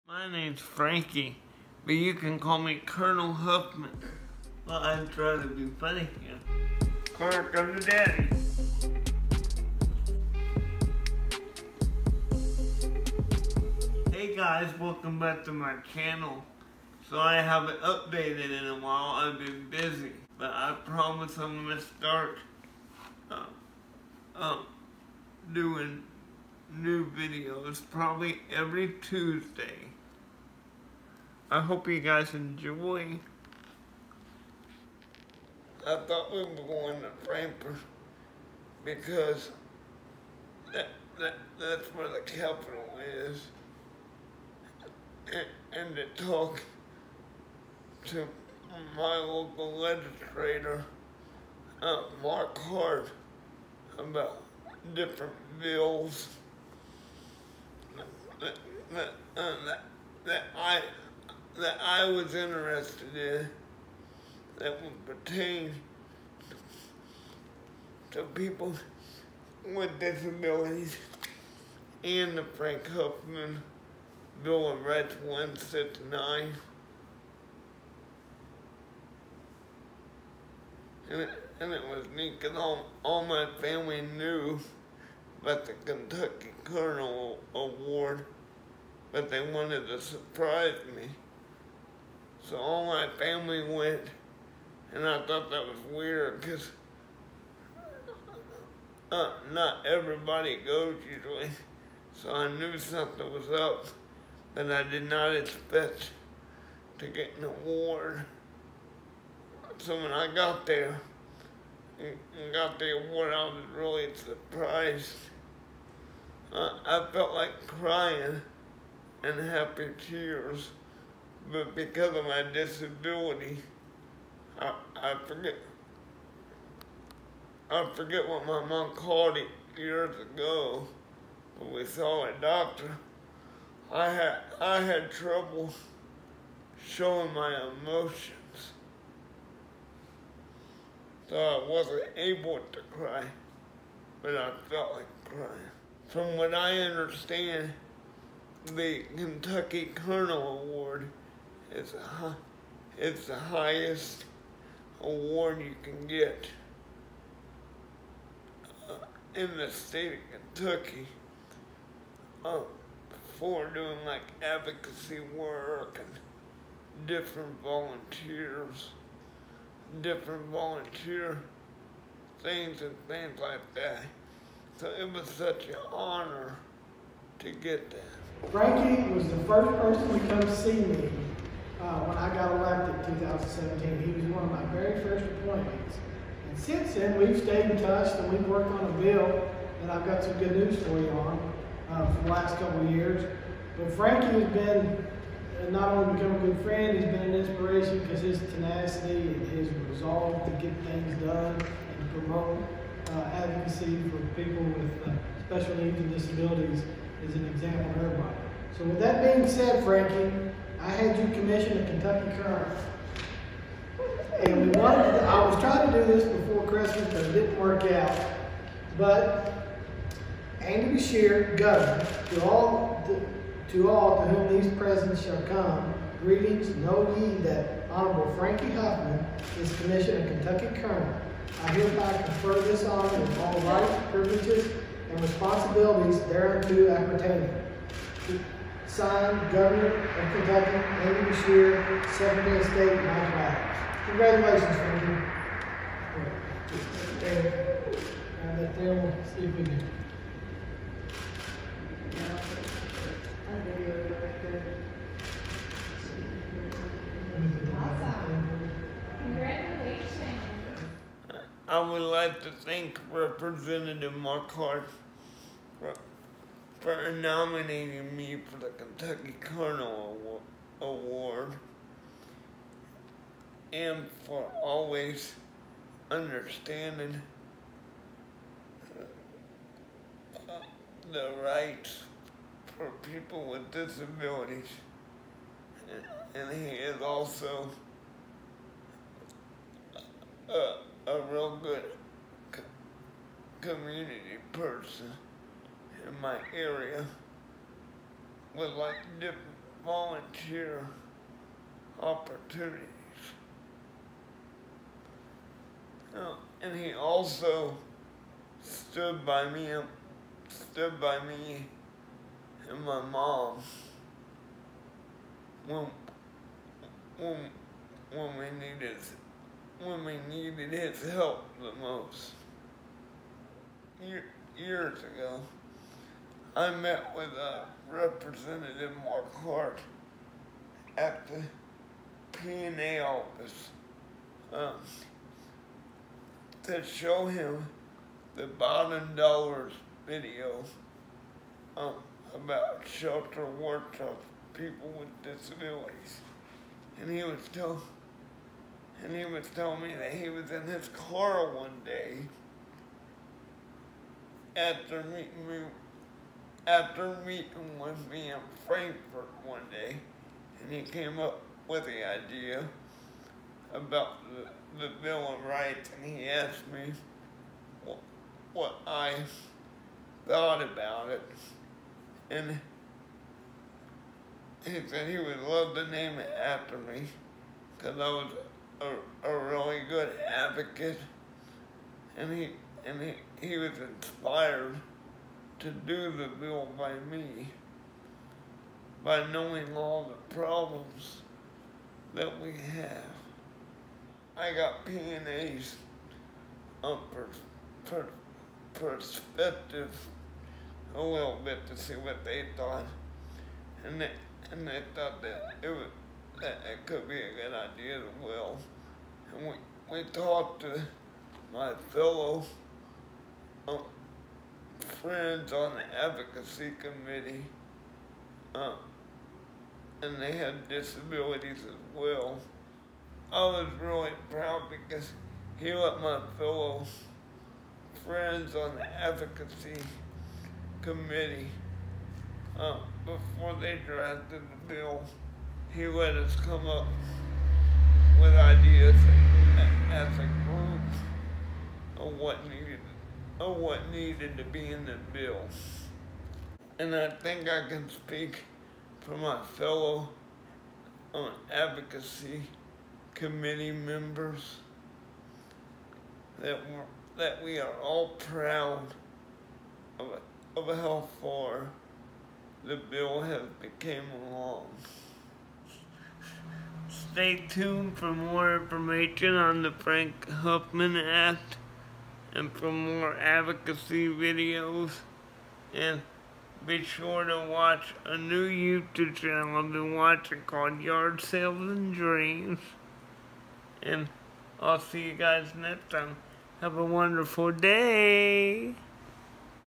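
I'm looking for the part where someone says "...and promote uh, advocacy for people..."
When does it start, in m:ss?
3:21.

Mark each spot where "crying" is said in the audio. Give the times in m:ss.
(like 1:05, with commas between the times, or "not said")
1:57, 2:25.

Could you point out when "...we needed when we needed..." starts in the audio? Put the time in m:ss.
5:18.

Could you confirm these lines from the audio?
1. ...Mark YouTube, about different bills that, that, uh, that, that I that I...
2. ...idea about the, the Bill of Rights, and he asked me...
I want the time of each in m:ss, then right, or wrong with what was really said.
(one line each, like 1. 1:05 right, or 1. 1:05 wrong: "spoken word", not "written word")
1. 0:52 wrong: "Hart", not "YouTube"
2. 6:02 right.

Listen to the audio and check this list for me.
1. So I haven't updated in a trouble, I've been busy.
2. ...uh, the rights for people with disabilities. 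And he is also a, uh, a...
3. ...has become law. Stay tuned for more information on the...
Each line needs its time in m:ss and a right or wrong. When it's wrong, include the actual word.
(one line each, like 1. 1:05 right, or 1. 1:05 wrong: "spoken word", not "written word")
1. 0:17 wrong: "while", not "trouble"
2. 4:40 right
3. 7:43 right.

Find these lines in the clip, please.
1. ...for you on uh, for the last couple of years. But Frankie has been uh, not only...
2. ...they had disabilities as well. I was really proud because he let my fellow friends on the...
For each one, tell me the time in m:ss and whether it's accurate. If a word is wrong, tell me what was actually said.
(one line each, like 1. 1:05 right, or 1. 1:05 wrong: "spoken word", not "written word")
1. 3:10 right
2. 7:00 right.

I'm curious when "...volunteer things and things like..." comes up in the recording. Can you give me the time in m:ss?
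2:50.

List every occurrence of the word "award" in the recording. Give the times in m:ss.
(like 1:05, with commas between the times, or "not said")
1:27, 1:47, 1:53, 2:30, 2:35, 4:30.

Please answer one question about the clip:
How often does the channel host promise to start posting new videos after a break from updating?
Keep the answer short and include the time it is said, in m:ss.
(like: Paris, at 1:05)
Every Tuesday, at 0:28.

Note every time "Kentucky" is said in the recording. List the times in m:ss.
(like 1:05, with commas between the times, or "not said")
1:25, 2:29, 2:40, 3:31, 3:50, 4:00, 4:28.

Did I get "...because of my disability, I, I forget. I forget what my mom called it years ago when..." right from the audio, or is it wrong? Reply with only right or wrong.
right.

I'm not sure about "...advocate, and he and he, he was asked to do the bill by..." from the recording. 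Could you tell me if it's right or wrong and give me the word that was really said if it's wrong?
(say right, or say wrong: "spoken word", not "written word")
wrong: "inspired", not "asked".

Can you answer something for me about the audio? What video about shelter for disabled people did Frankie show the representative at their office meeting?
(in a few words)
Biden Dollars.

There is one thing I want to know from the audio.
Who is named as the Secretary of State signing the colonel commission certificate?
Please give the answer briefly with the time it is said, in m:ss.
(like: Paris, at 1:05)
Mike Adams, at 4:02.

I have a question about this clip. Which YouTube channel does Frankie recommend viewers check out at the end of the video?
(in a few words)
Yard Sales and Dreams.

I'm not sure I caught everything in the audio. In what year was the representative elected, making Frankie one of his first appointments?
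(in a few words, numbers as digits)
2017.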